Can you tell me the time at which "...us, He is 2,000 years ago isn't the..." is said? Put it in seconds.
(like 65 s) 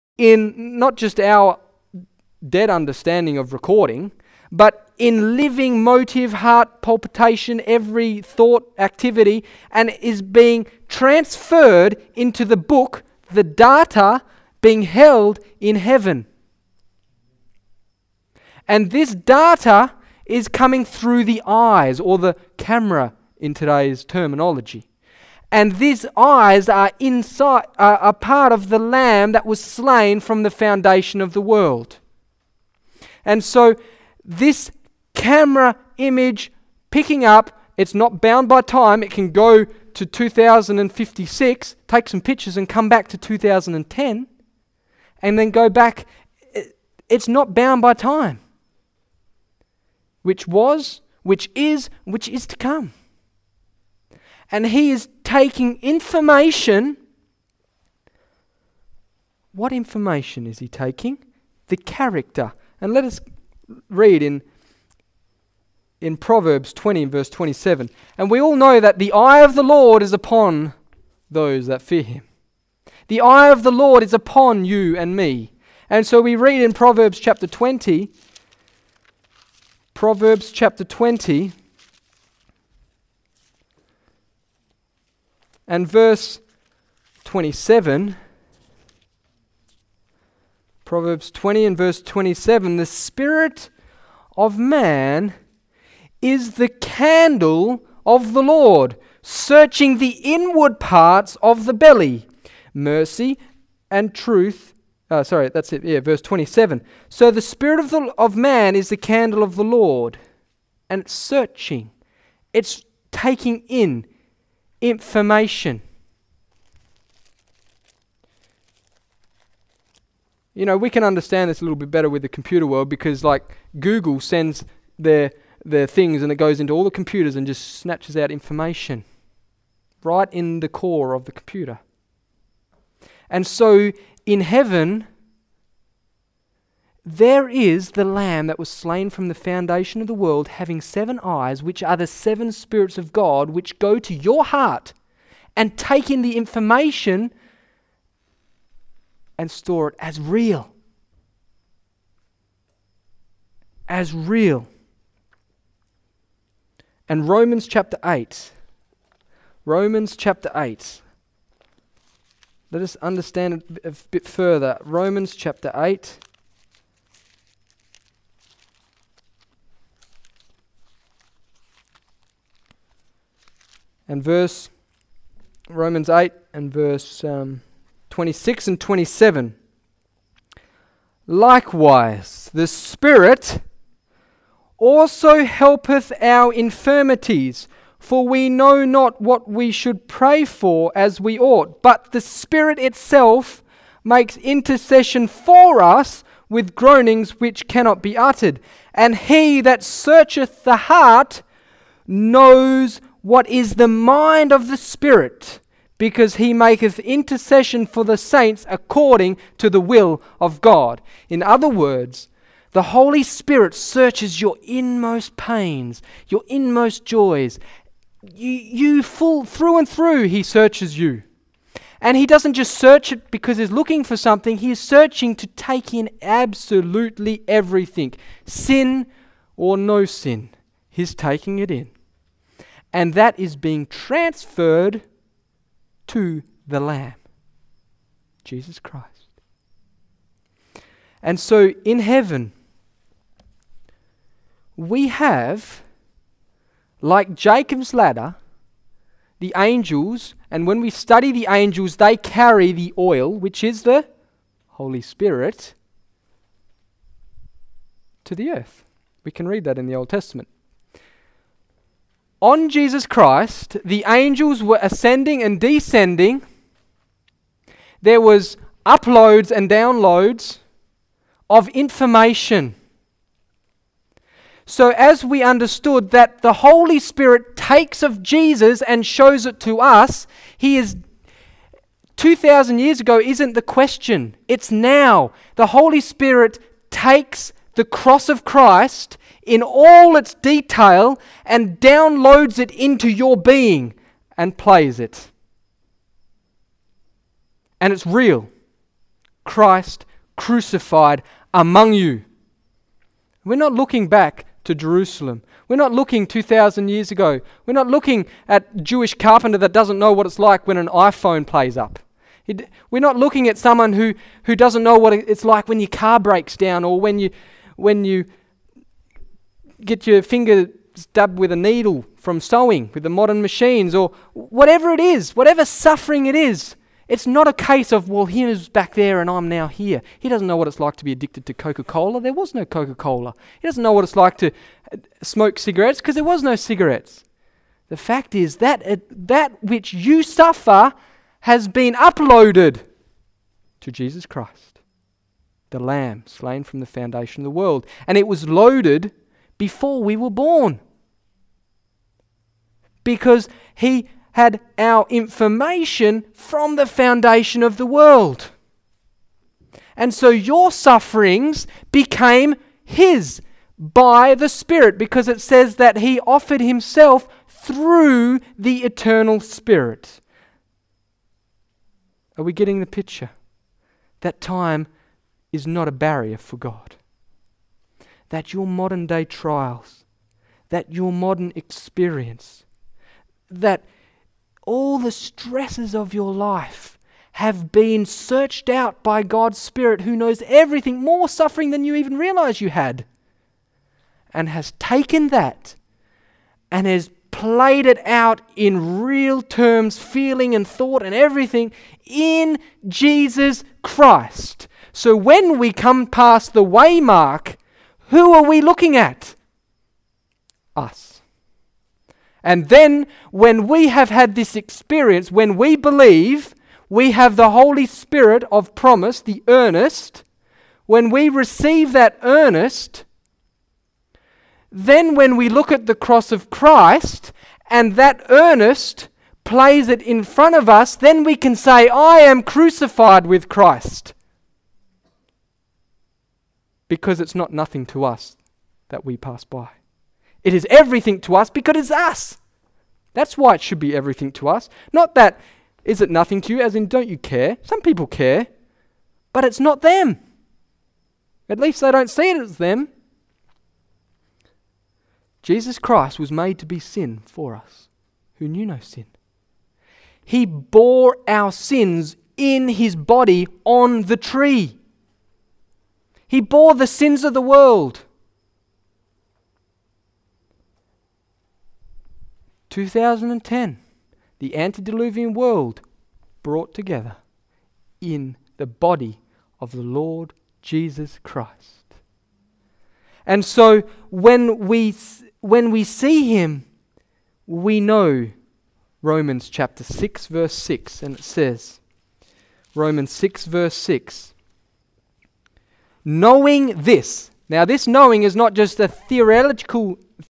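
279 s.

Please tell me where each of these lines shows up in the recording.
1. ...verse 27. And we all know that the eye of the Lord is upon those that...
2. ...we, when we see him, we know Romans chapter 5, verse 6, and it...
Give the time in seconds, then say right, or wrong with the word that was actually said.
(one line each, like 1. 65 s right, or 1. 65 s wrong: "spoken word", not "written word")
1. 67 s right
2. 484 s wrong: "6", not "5".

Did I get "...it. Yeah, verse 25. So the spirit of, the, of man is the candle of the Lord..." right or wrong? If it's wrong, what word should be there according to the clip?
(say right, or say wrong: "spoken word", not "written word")
wrong: "27", not "25".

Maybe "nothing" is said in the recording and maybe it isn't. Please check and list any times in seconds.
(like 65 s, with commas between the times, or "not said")
437 s, 446 s.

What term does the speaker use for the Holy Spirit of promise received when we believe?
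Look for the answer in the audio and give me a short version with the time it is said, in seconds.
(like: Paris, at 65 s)
the earnest, at 419 s.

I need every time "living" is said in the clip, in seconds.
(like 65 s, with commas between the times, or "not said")
5 s.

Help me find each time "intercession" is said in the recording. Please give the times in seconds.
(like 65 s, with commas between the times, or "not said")
194 s, 206 s.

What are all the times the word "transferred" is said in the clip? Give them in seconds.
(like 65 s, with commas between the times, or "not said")
10 s, 233 s.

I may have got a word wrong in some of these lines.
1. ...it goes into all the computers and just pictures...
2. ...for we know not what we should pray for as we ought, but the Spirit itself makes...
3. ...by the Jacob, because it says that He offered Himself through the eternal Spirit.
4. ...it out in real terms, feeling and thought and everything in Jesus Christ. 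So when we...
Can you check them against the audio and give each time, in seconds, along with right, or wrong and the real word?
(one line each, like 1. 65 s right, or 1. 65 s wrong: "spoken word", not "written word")
1. 126 s wrong: "snatches", not "pictures"
2. 187 s right
3. 363 s wrong: "Spirit", not "Jacob"
4. 397 s right.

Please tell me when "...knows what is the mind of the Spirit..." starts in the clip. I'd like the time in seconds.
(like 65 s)
202 s.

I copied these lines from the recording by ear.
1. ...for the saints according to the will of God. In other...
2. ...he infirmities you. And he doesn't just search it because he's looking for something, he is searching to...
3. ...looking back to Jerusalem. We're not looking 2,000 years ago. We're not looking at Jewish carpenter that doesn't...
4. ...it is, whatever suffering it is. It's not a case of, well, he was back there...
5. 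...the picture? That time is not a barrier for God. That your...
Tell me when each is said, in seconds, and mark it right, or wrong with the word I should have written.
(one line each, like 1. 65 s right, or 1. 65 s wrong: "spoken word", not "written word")
1. 207 s right
2. 220 s wrong: "searches", not "infirmities"
3. 303 s right
4. 324 s right
5. 372 s right.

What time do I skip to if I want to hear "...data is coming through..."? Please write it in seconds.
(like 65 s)
19 s.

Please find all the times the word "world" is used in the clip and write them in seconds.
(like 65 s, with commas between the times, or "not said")
31 s, 122 s, 140 s, 347 s, 357 s, 467 s, 475 s.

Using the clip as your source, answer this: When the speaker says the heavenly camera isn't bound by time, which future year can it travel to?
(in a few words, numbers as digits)
2056.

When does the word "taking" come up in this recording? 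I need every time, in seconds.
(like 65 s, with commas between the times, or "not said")
55 s, 60 s, 113 s, 231 s.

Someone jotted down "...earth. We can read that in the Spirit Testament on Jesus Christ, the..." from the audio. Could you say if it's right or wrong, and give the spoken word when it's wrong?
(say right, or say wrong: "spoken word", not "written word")
wrong: "Old", not "Spirit".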